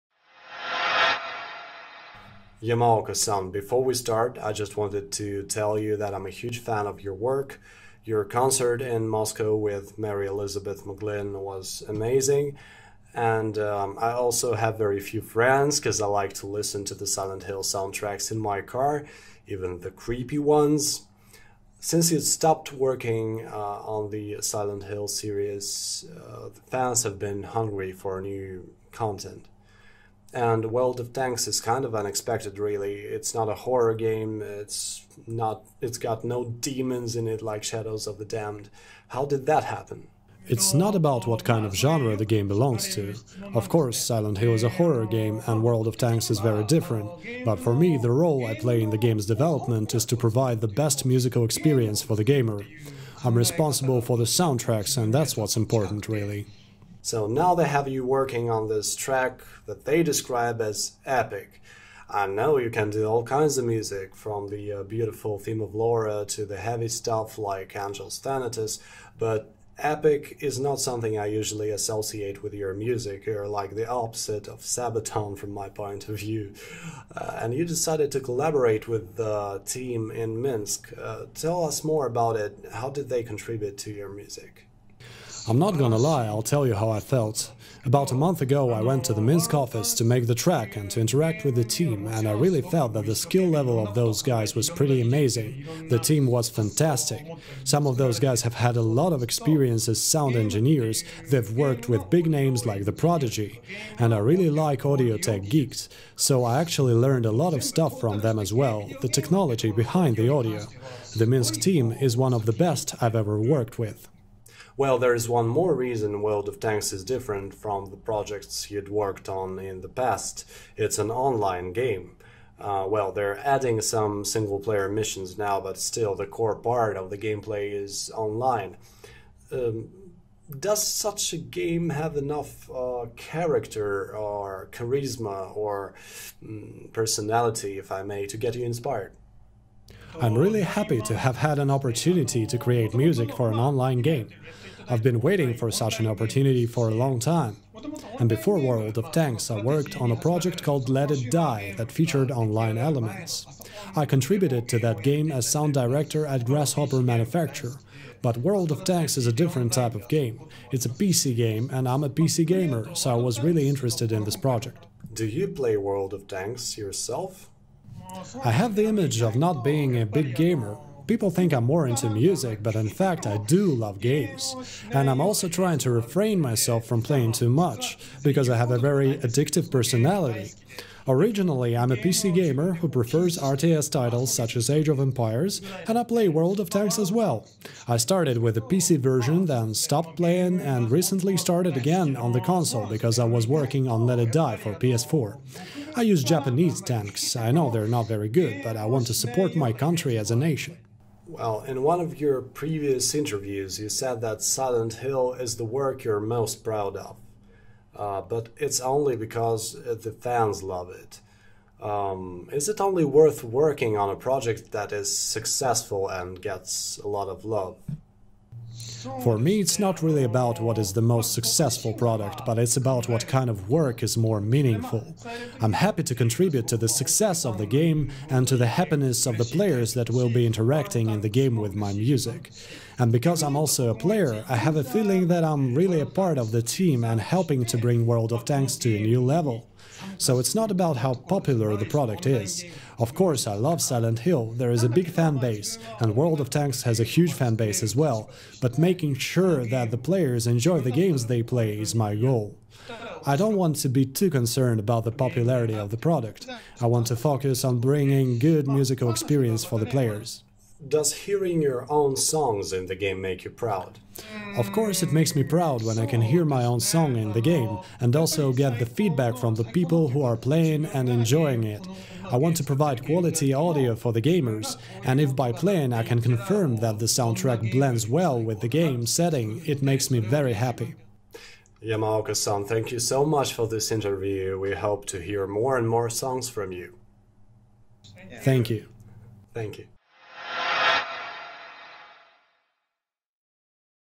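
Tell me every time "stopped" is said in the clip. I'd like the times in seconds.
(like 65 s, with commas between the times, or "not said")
22 s, 189 s.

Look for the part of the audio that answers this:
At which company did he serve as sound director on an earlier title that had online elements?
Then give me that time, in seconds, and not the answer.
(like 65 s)
156 s.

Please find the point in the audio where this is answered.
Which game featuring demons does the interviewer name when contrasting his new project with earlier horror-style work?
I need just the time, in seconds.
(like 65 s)
37 s.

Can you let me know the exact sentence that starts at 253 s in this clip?
I don't want to be too concerned about the popularity of the product.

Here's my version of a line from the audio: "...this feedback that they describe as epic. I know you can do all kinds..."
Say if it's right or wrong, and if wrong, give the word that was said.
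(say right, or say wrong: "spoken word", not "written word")
wrong: "track", not "feedback".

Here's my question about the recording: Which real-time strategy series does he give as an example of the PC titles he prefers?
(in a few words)
Age of Empires.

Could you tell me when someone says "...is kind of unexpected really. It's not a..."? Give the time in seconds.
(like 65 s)
31 s.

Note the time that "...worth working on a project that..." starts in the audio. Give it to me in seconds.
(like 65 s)
213 s.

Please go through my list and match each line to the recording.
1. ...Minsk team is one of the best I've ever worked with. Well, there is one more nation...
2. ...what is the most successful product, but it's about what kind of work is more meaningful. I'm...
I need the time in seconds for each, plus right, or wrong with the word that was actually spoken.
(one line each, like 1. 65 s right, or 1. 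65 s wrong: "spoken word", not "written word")
1. 111 s wrong: "reason", not "nation"
2. 220 s right.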